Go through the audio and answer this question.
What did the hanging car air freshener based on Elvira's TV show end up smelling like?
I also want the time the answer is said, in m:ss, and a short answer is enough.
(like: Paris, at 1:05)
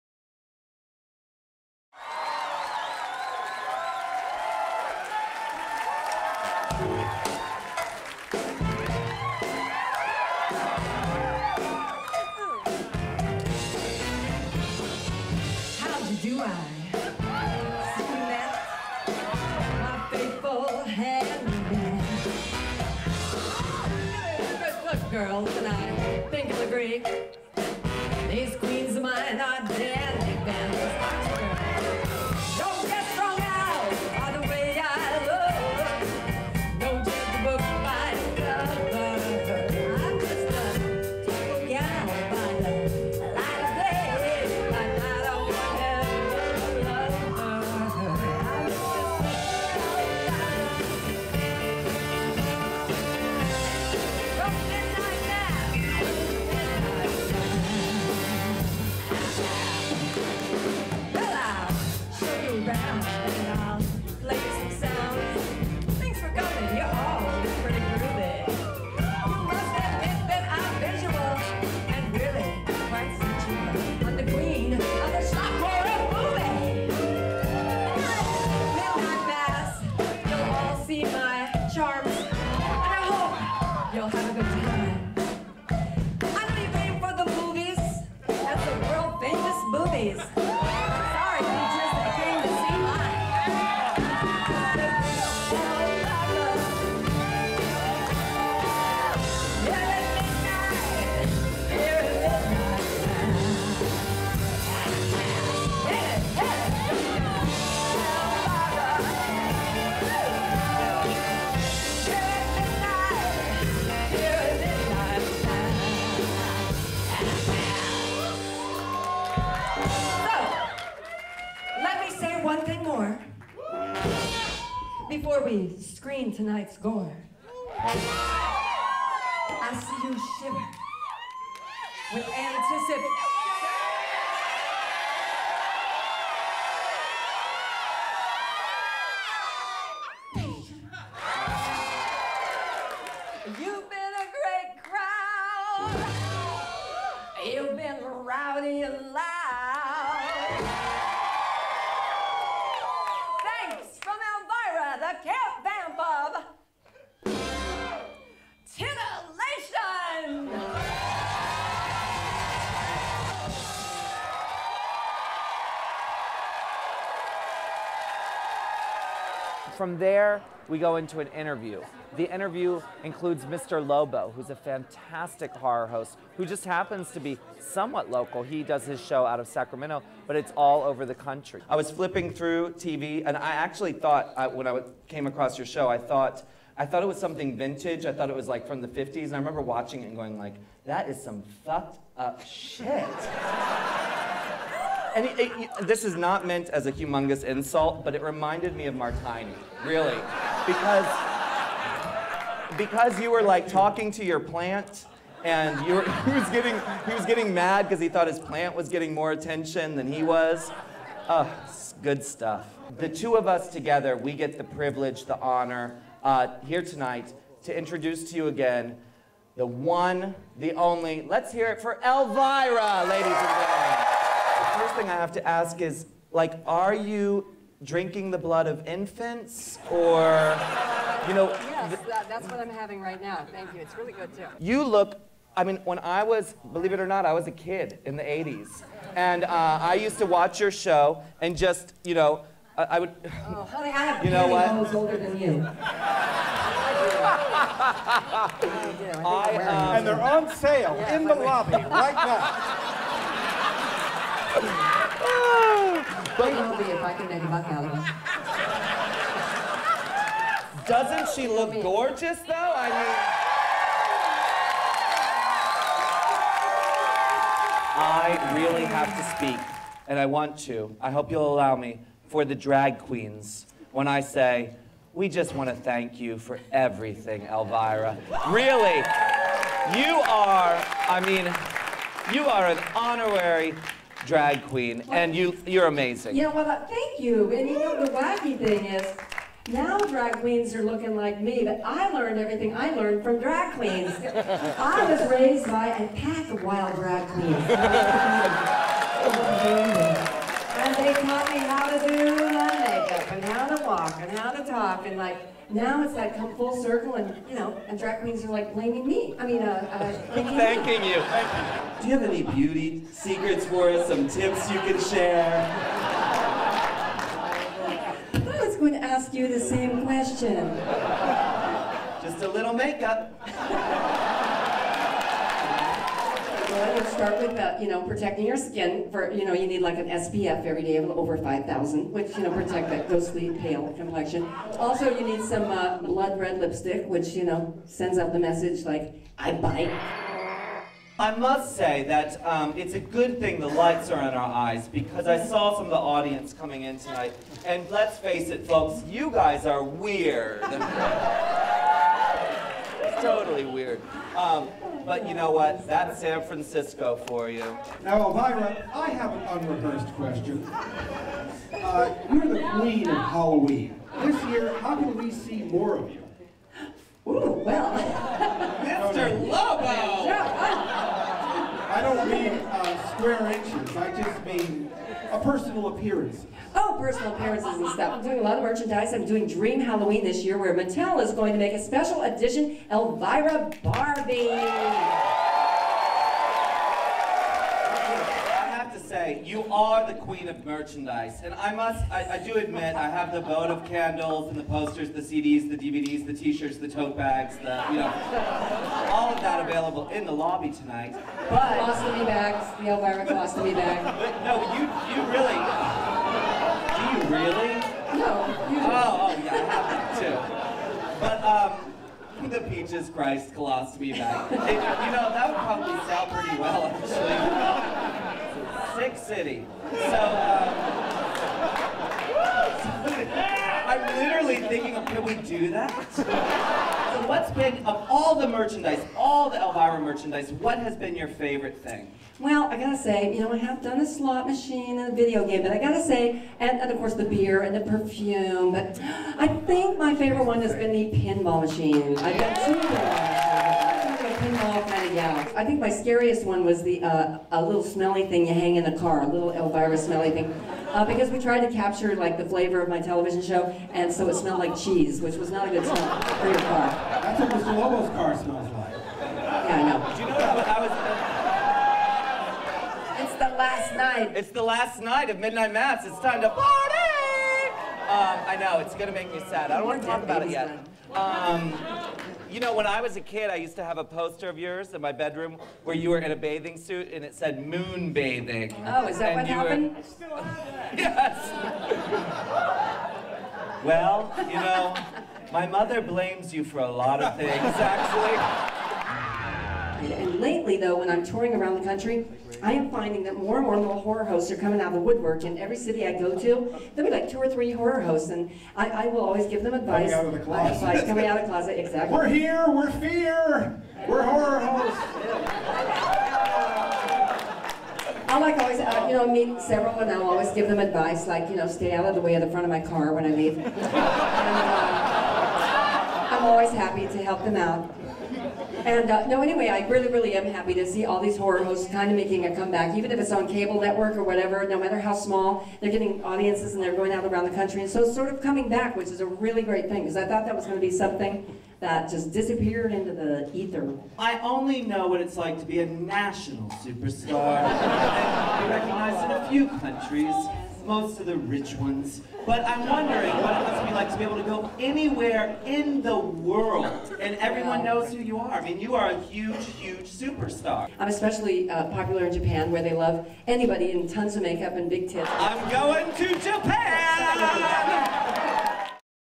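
cheese, at 7:34.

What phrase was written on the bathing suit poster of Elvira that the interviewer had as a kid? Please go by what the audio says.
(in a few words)
moon bathing.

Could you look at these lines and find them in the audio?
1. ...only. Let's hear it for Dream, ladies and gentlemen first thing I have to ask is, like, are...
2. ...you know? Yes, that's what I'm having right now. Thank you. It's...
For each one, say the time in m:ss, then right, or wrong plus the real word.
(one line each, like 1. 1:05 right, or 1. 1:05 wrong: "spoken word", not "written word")
1. 3:40 wrong: "Elvira", not "Dream"
2. 3:51 right.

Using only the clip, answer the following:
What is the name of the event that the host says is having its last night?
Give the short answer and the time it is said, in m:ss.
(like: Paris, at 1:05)
Midnight Mass, at 7:45.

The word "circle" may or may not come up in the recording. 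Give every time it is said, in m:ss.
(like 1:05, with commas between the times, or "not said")
5:06.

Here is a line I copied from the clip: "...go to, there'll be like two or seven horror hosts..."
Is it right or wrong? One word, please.
wrong.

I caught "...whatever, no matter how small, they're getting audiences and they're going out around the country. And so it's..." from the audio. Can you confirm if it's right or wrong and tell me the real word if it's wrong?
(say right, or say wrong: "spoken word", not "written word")
right.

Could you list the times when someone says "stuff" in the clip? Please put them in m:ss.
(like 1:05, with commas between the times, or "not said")
3:32, 6:17.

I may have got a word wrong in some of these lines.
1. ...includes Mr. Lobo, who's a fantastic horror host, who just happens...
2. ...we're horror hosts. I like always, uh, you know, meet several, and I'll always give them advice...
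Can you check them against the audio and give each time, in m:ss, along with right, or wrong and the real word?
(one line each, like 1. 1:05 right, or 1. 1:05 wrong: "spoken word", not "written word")
1. 2:53 right
2. 8:24 right.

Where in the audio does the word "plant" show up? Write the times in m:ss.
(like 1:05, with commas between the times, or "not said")
3:24, 3:28.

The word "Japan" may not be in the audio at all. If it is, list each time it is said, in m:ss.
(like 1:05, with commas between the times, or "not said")
9:12, 9:16.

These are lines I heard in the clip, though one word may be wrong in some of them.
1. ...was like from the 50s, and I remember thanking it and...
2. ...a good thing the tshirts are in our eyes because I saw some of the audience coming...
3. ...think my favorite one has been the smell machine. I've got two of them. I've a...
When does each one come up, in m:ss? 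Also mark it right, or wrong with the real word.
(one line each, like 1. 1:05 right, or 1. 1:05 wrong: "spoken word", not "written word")
1. 3:08 wrong: "watching", not "thanking"
2. 5:42 wrong: "lights", not "tshirts"
3. 7:19 wrong: "pinball", not "smell".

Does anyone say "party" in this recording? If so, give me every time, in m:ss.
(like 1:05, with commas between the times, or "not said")
7:46.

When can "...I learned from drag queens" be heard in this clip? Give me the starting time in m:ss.
4:52.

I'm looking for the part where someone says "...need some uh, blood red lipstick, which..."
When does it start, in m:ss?
5:35.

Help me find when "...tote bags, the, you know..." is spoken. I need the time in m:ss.
6:36.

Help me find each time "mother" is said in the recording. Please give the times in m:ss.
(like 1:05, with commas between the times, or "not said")
8:05.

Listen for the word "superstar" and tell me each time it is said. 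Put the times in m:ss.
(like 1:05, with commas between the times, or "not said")
8:56, 9:10.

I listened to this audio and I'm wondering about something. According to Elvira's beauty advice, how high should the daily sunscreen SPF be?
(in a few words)
5,000.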